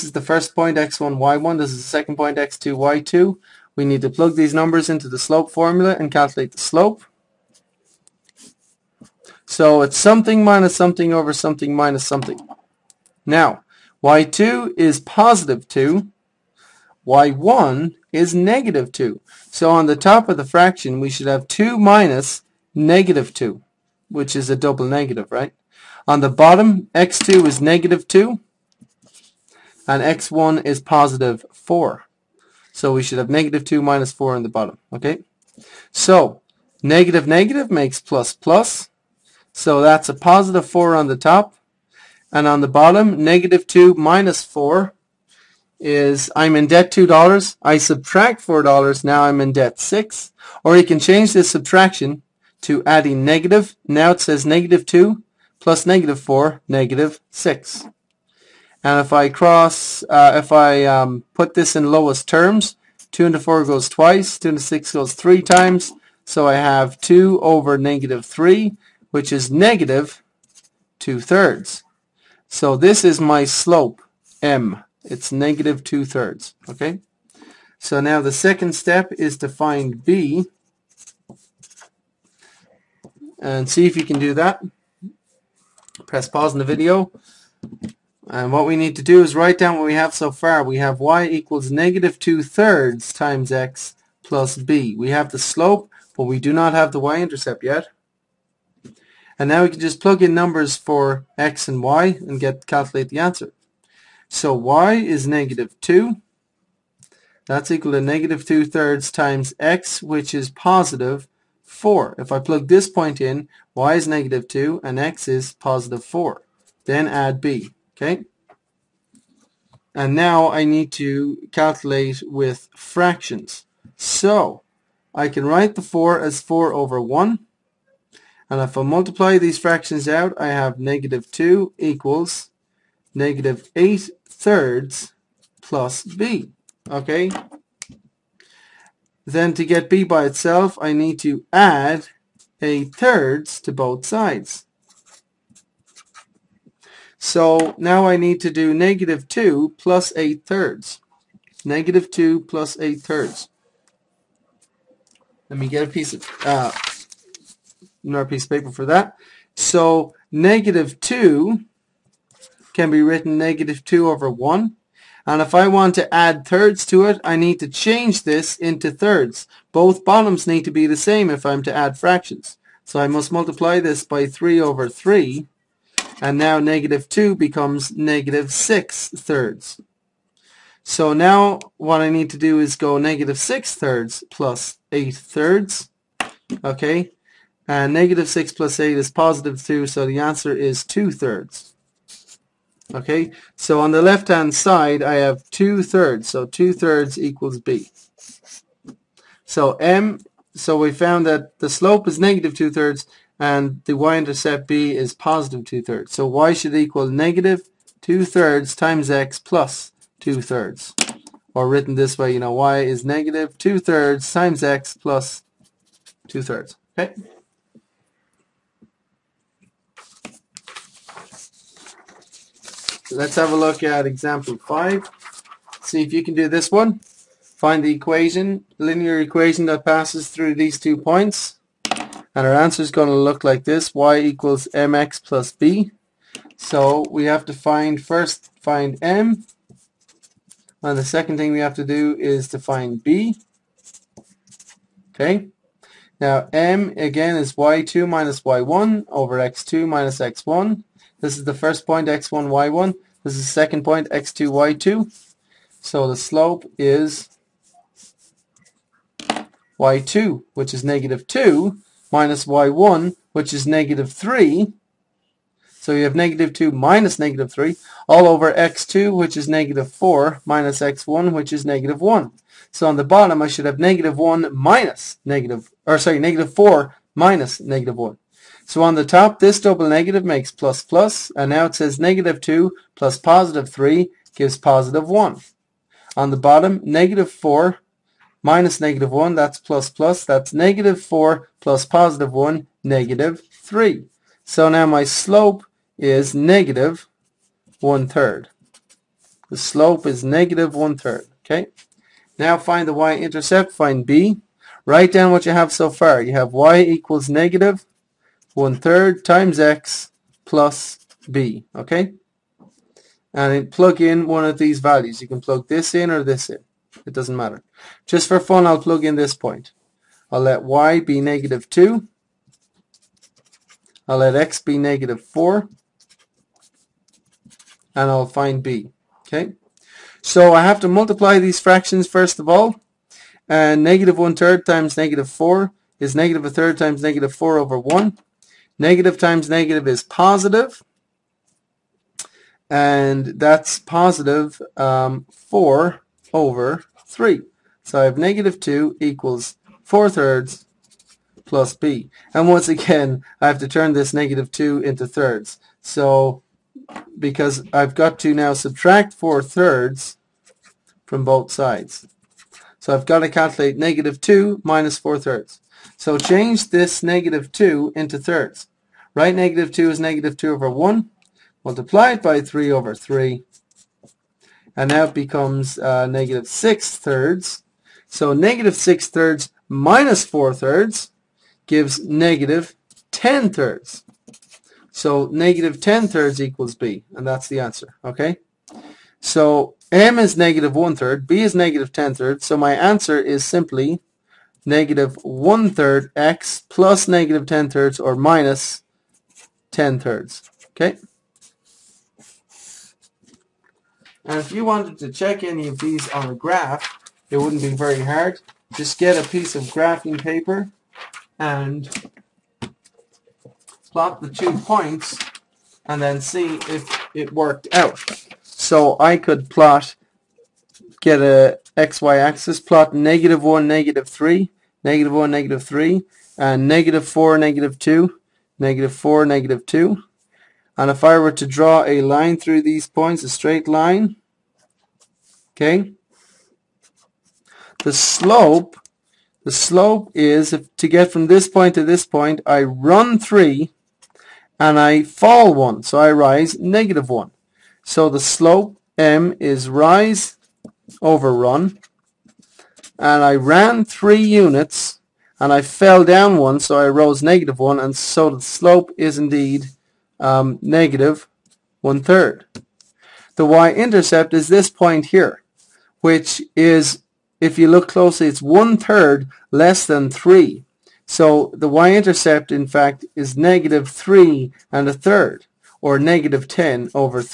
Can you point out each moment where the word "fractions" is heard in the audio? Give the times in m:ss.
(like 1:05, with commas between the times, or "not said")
0:20, 2:02, 2:09, 2:51, 5:31.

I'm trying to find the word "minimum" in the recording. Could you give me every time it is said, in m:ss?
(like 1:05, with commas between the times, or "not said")
not said.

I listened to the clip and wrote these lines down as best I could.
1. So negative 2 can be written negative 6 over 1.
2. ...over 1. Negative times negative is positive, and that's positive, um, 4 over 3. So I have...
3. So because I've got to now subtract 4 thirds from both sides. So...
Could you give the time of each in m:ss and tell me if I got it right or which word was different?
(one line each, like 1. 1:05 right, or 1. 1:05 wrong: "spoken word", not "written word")
1. 2:39 wrong: "2", not "6"
2. 5:37 right
3. 5:55 right.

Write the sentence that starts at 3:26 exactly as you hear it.
So Y should equal negative 2 thirds times X plus 2 thirds.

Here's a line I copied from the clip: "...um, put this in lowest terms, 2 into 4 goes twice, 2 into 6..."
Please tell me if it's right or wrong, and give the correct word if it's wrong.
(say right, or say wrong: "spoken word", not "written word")
right.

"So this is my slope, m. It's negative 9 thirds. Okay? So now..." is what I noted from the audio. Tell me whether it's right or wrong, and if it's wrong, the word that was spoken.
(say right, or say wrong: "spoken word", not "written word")
wrong: "2", not "9".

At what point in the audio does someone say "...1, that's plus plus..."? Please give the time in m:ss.
4:49.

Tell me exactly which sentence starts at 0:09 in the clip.
So it's something minus something over something minus something.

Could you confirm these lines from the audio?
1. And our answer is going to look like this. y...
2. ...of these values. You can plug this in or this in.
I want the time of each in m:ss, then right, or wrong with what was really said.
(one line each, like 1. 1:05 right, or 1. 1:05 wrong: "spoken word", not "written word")
1. 3:51 right
2. 5:14 right.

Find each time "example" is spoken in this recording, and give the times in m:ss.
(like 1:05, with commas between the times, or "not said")
3:44.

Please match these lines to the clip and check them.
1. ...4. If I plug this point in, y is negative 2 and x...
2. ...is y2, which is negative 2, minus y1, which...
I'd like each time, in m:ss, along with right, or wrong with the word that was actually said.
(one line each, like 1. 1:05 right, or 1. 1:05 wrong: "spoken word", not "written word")
1. 1:51 right
2. 4:16 right.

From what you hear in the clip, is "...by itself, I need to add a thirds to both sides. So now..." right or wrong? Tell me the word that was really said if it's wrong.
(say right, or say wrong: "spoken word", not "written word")
right.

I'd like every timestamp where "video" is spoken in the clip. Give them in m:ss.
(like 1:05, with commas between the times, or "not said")
1:26.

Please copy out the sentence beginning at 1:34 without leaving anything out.
We have the slope, but we do not have the y-intercept yet.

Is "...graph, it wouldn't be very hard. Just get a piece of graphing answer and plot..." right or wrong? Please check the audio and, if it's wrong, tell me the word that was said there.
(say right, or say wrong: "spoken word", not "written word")
wrong: "paper", not "answer".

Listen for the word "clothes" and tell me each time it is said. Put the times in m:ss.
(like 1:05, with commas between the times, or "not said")
not said.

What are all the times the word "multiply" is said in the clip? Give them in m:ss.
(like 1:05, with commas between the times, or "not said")
2:08, 2:53, 5:30, 6:11.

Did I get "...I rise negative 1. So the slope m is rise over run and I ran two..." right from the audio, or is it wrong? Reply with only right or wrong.
wrong.